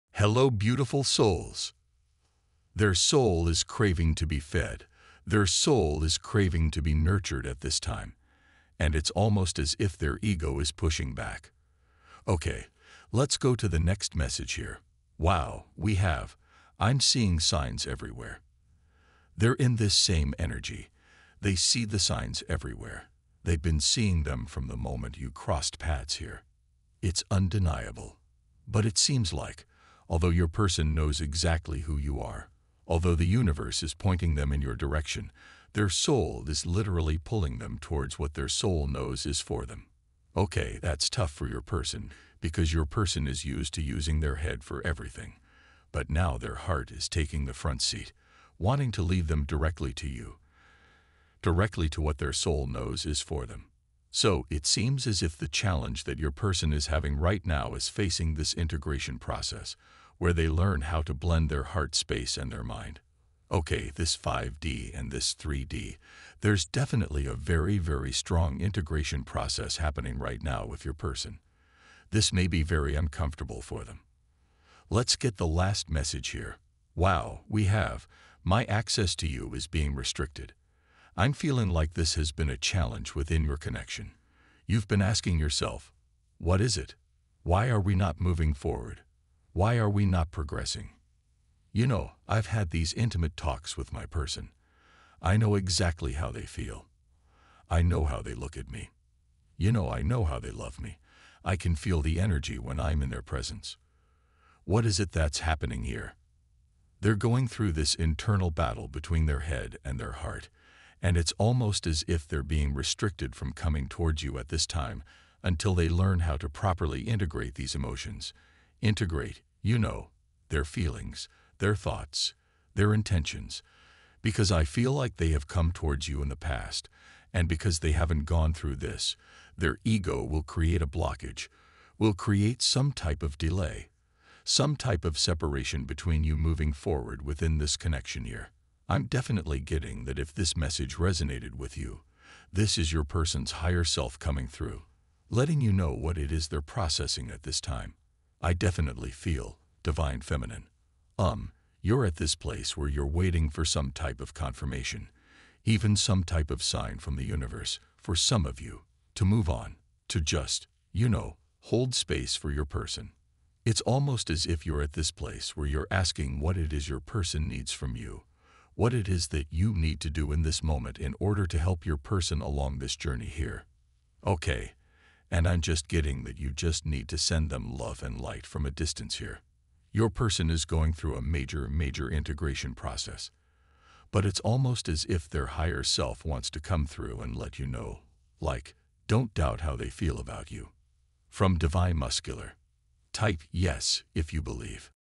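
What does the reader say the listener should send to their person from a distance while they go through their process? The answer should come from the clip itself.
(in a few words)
love and light.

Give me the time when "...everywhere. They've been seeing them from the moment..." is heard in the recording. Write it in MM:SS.
00:22.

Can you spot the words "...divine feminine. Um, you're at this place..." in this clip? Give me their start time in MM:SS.
02:29.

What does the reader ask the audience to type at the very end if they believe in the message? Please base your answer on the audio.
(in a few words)
yes.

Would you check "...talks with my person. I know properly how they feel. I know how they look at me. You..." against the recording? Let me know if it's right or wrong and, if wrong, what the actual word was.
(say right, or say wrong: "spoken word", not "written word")
wrong: "exactly", not "properly".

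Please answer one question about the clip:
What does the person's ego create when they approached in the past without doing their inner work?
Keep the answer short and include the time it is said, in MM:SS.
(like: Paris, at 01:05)
a blockage, at 02:10.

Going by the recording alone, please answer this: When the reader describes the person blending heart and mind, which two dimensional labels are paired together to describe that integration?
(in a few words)
5D and 3D.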